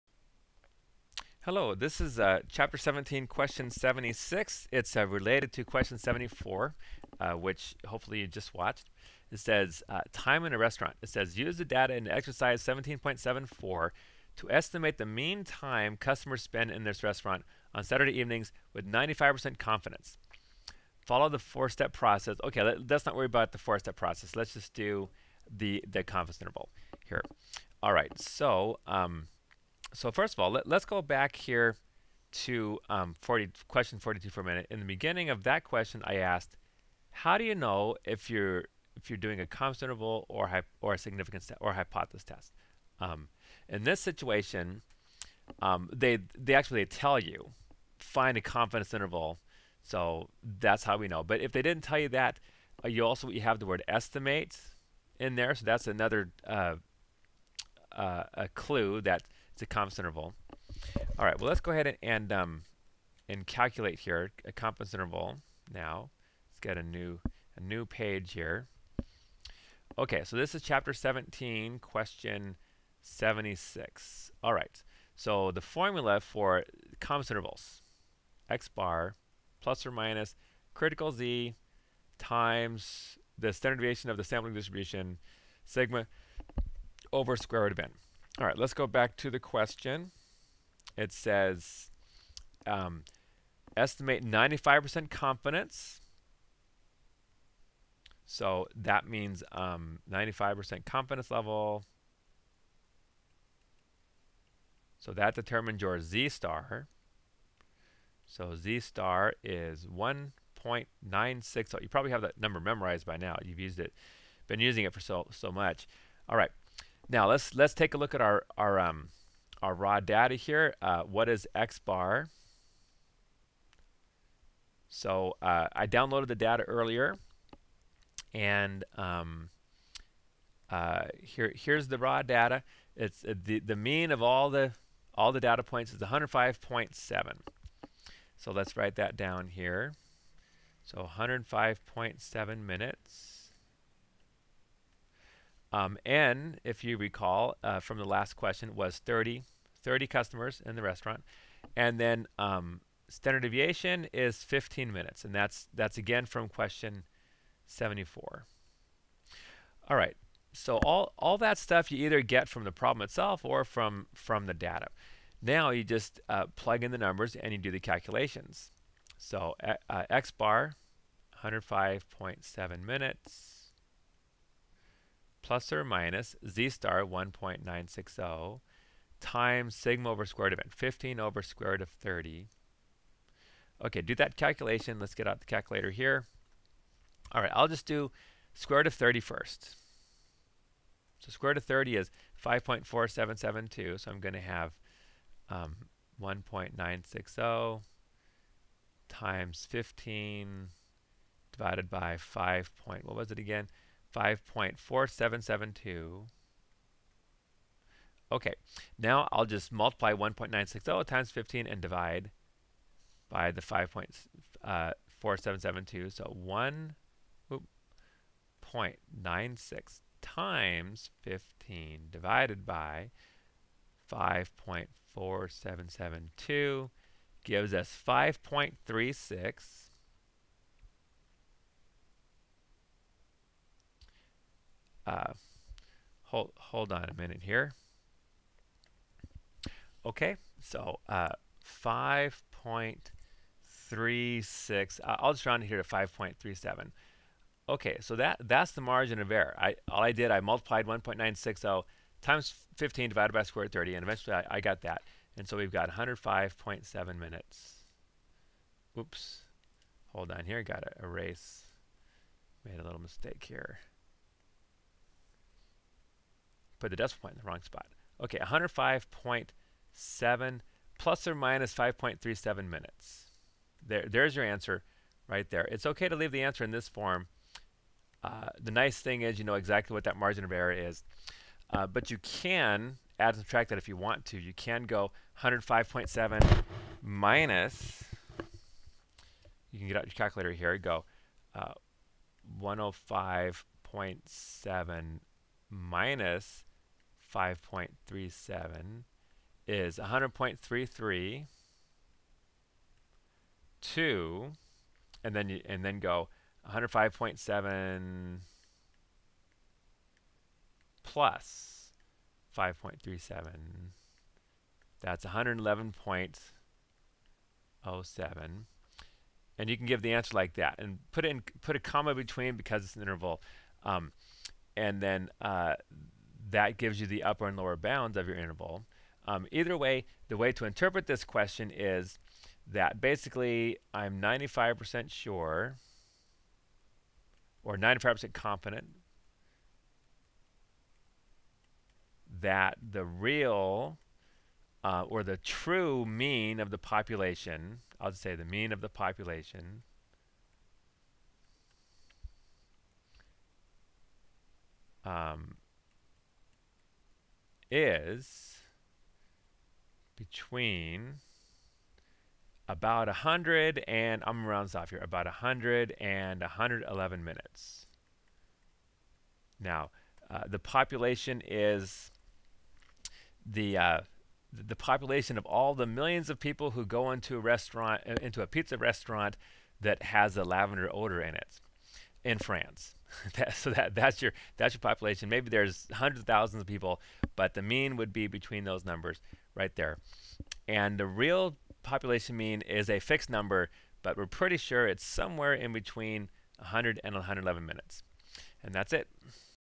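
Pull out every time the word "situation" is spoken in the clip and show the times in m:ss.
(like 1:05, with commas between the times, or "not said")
0:43.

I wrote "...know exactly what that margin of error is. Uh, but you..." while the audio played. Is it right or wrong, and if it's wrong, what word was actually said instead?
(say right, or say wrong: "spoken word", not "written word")
right.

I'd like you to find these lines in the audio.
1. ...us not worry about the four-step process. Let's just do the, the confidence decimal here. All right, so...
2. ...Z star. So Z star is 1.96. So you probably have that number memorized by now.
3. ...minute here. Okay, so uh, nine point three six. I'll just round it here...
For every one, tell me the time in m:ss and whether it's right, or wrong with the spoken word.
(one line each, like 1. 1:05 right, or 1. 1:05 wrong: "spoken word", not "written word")
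1. 0:22 wrong: "interval", not "decimal"
2. 1:45 right
3. 3:57 wrong: "five", not "nine".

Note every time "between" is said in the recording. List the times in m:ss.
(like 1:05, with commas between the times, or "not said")
5:22, 6:00, 6:28, 6:35.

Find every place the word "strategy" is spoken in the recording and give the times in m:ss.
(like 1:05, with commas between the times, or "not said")
not said.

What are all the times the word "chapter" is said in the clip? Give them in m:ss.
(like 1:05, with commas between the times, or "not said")
0:02, 1:10.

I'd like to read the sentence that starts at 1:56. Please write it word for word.
All right, now let's let's take a look at our our um, our raw data here.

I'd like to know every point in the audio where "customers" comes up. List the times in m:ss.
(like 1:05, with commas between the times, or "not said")
0:15, 2:30.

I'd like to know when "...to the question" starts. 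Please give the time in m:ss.
1:29.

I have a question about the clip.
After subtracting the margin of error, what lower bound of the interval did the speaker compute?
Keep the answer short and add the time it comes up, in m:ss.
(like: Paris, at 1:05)
100.33, at 4:59.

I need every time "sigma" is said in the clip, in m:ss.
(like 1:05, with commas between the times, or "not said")
1:25, 2:59.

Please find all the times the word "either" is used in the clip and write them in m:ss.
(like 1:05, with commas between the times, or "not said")
2:42, 5:29.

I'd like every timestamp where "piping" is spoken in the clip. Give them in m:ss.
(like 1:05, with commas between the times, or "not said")
not said.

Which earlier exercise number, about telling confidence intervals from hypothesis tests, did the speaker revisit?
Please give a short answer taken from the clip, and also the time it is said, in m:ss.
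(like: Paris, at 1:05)
42, at 0:33.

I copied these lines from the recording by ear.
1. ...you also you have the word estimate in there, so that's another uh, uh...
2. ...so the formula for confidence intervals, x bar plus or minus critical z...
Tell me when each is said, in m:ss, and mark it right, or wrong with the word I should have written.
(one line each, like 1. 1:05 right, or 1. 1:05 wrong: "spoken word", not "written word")
1. 0:52 right
2. 1:15 right.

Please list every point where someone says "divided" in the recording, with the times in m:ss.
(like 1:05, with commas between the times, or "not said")
3:21, 4:13.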